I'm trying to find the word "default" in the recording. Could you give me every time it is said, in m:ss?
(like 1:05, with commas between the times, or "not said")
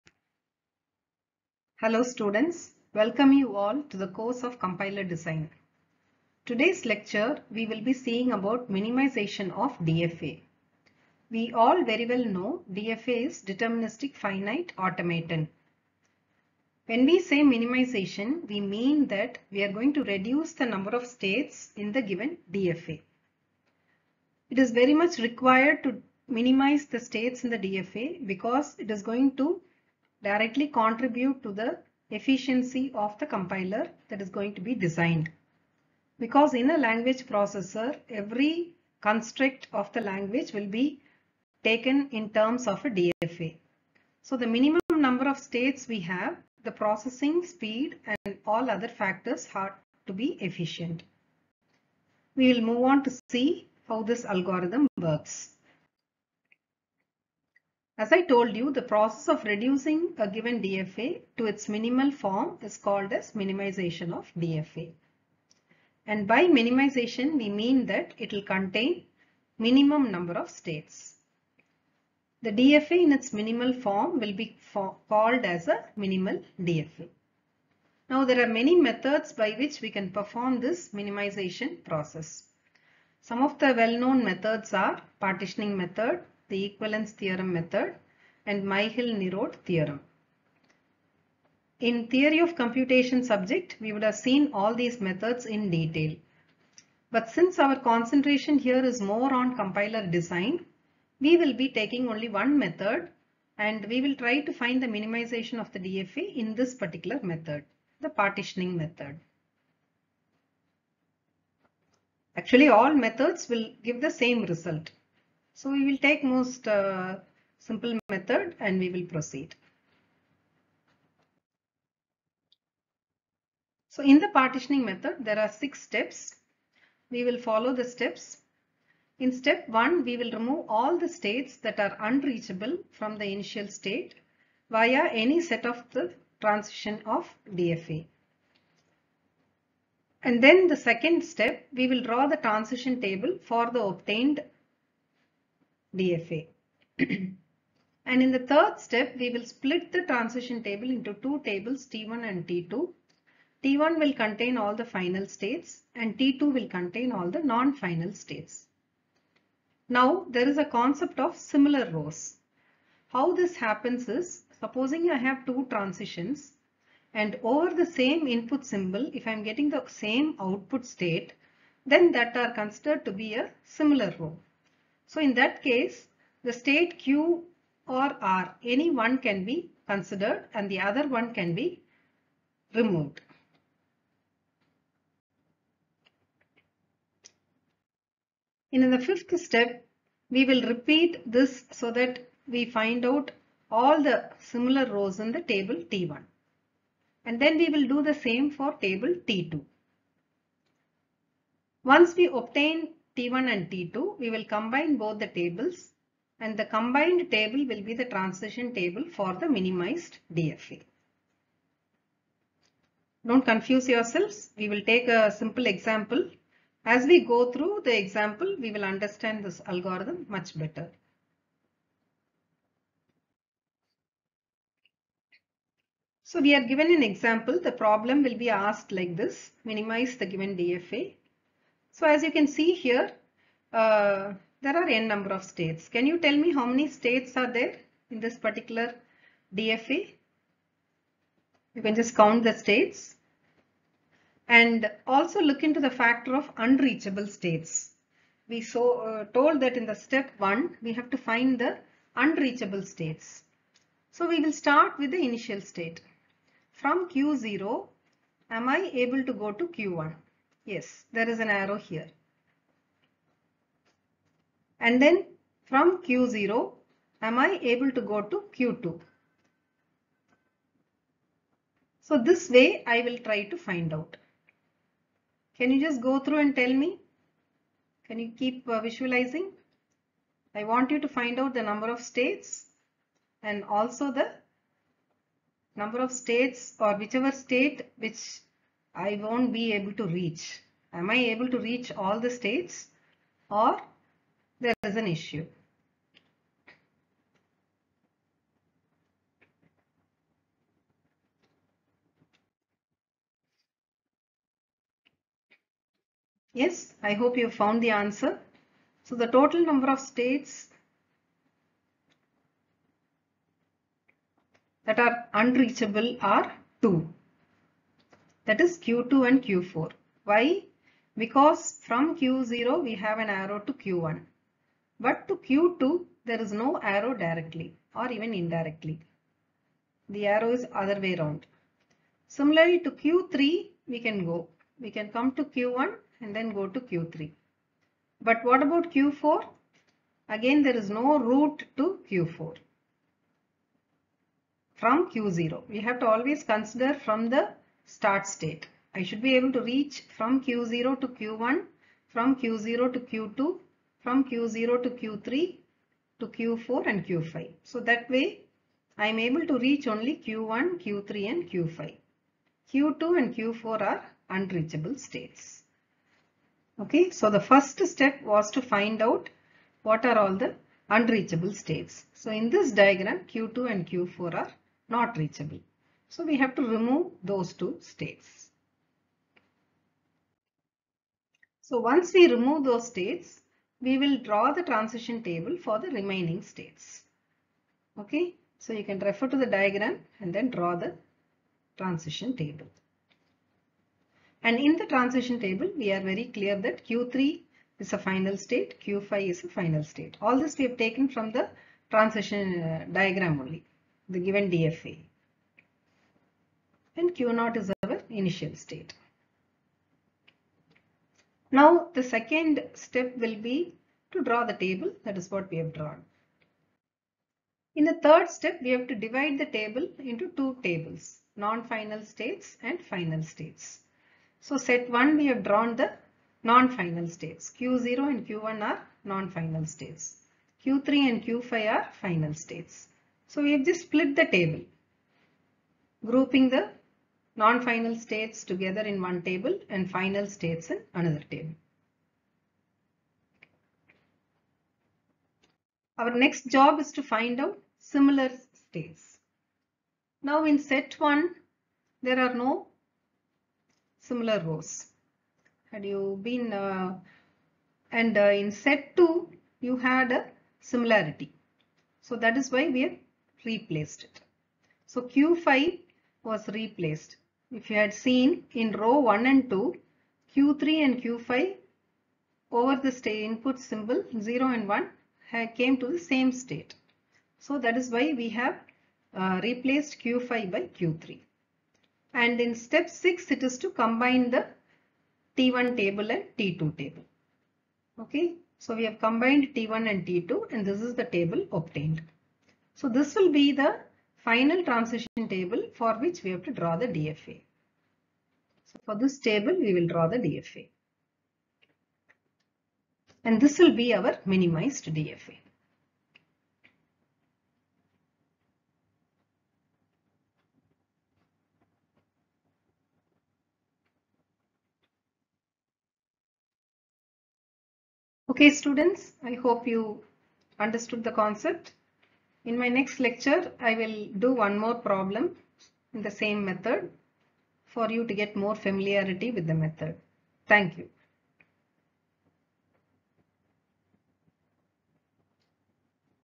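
not said.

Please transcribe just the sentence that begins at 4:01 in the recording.
You can just count the states and also look into the factor of unreachable states.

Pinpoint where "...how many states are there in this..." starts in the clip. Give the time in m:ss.
3:56.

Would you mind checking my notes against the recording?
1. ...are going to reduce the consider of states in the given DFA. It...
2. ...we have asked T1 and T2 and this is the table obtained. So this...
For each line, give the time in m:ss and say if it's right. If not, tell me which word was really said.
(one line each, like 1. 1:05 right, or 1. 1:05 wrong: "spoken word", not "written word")
1. 0:19 wrong: "number", not "consider"
2. 8:08 wrong: "combined", not "asked".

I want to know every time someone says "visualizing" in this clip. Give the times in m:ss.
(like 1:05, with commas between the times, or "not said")
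4:38.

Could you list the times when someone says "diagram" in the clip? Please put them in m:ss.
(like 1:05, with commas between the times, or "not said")
6:12, 6:29, 6:42.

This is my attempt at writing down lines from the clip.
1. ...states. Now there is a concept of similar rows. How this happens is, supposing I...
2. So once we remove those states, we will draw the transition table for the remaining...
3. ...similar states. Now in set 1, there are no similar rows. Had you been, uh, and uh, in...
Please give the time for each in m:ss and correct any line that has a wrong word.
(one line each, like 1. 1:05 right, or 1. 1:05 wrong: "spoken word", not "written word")
1. 2:38 right
2. 6:21 right
3. 7:27 right.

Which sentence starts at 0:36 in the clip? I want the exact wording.
Because in a language processor, every construct of the language will be taken in terms of a DFA.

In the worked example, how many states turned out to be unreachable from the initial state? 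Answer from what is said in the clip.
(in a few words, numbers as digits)
2.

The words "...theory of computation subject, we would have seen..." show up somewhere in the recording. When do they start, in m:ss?
1:32.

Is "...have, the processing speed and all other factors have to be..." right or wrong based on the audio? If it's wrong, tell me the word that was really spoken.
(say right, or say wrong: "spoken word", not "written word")
right.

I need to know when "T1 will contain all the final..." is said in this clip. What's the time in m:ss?
2:33.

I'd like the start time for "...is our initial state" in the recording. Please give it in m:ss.
6:47.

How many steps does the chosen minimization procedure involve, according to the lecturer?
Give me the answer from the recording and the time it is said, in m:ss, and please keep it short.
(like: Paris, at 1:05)
6, at 2:05.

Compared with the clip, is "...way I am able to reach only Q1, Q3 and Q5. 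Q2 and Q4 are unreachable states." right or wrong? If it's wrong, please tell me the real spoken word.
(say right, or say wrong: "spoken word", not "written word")
right.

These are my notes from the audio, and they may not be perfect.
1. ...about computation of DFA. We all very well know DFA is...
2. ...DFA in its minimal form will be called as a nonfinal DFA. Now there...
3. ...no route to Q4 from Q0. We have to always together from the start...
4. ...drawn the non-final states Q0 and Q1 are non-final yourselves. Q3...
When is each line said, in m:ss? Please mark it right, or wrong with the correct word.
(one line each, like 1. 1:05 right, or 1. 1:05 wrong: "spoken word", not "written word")
1. 0:08 wrong: "minimization", not "computation"
2. 1:12 wrong: "minimal", not "nonfinal"
3. 5:40 wrong: "consider", not "together"
4. 7:05 wrong: "states", not "yourselves".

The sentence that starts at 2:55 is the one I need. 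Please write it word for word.
So in that case, the state Q or R, any one can be considered and the other one can be removed.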